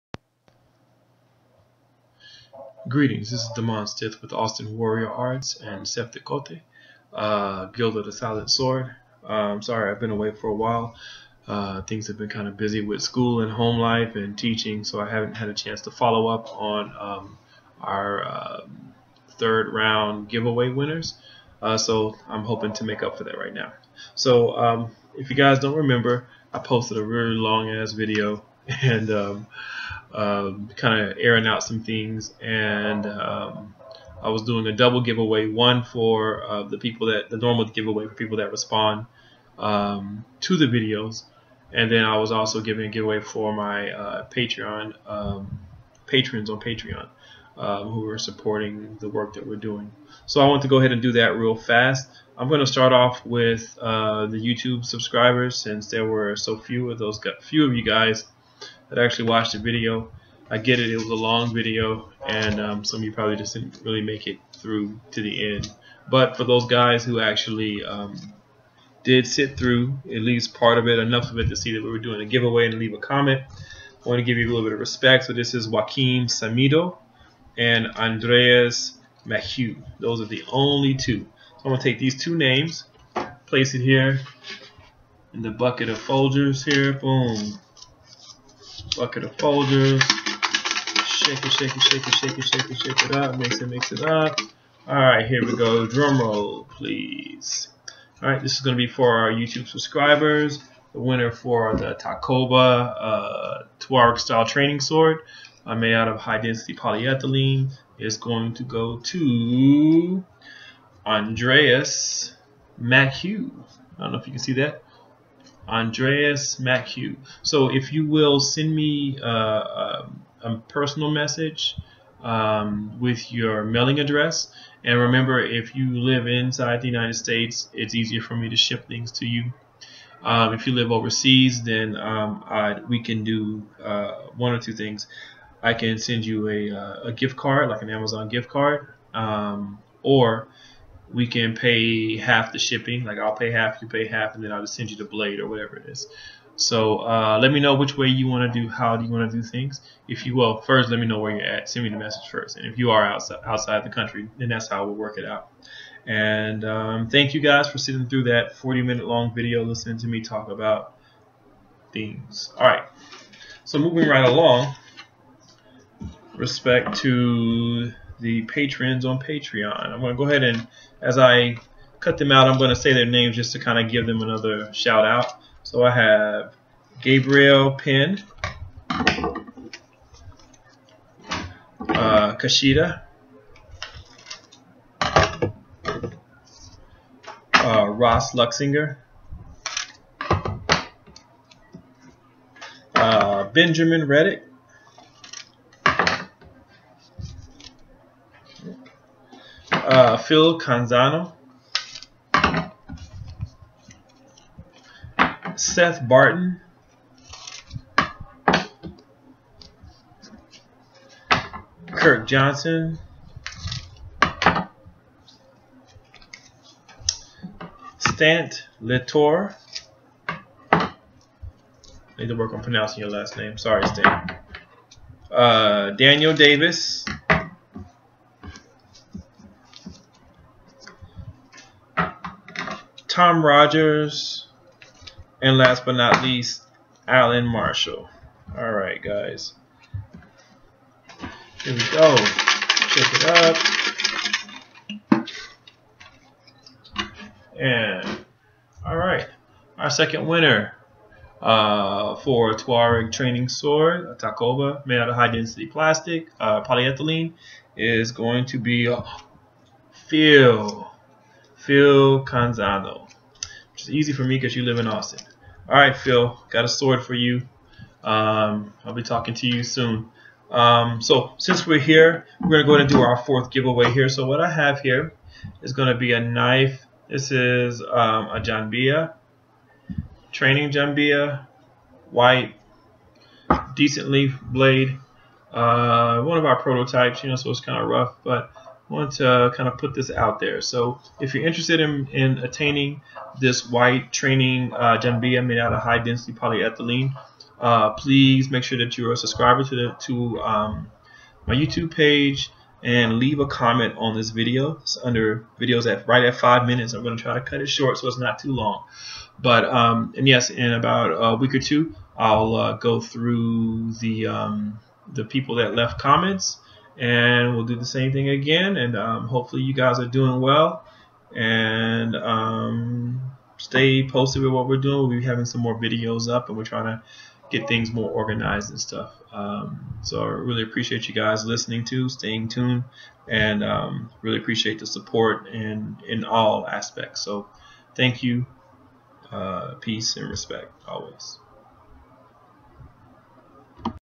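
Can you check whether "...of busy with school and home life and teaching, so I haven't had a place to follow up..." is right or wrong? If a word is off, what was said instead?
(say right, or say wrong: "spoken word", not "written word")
wrong: "chance", not "place".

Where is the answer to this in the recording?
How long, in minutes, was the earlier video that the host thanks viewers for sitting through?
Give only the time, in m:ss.
2:38.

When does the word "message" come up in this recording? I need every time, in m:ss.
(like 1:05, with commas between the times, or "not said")
2:01, 2:31.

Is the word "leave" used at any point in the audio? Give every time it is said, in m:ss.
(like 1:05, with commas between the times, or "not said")
1:12, 5:03.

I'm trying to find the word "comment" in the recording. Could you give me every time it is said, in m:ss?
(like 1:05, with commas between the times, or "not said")
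1:12, 5:03, 5:15.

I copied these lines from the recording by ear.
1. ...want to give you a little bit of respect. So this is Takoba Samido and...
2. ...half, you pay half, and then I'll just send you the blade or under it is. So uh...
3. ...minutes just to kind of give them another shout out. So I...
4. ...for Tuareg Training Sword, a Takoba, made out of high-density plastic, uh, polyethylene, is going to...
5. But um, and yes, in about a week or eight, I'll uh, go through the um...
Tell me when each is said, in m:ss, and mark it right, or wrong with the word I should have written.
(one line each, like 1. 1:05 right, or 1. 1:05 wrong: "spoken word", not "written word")
1. 1:14 wrong: "Joaquim", not "Takoba"
2. 2:23 wrong: "whatever", not "under"
3. 2:53 wrong: "names", not "minutes"
4. 4:12 right
5. 5:09 wrong: "two", not "eight".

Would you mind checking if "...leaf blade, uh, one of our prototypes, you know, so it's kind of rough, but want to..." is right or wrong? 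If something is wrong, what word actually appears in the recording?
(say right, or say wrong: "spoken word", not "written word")
right.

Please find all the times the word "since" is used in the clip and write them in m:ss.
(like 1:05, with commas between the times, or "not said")
0:55, 4:31.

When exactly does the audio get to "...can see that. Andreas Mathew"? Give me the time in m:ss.
1:54.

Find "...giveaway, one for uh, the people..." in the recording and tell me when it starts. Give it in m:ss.
0:34.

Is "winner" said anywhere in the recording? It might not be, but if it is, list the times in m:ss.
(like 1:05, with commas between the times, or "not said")
0:20, 1:40, 4:10.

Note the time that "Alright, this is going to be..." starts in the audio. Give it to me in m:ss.
1:38.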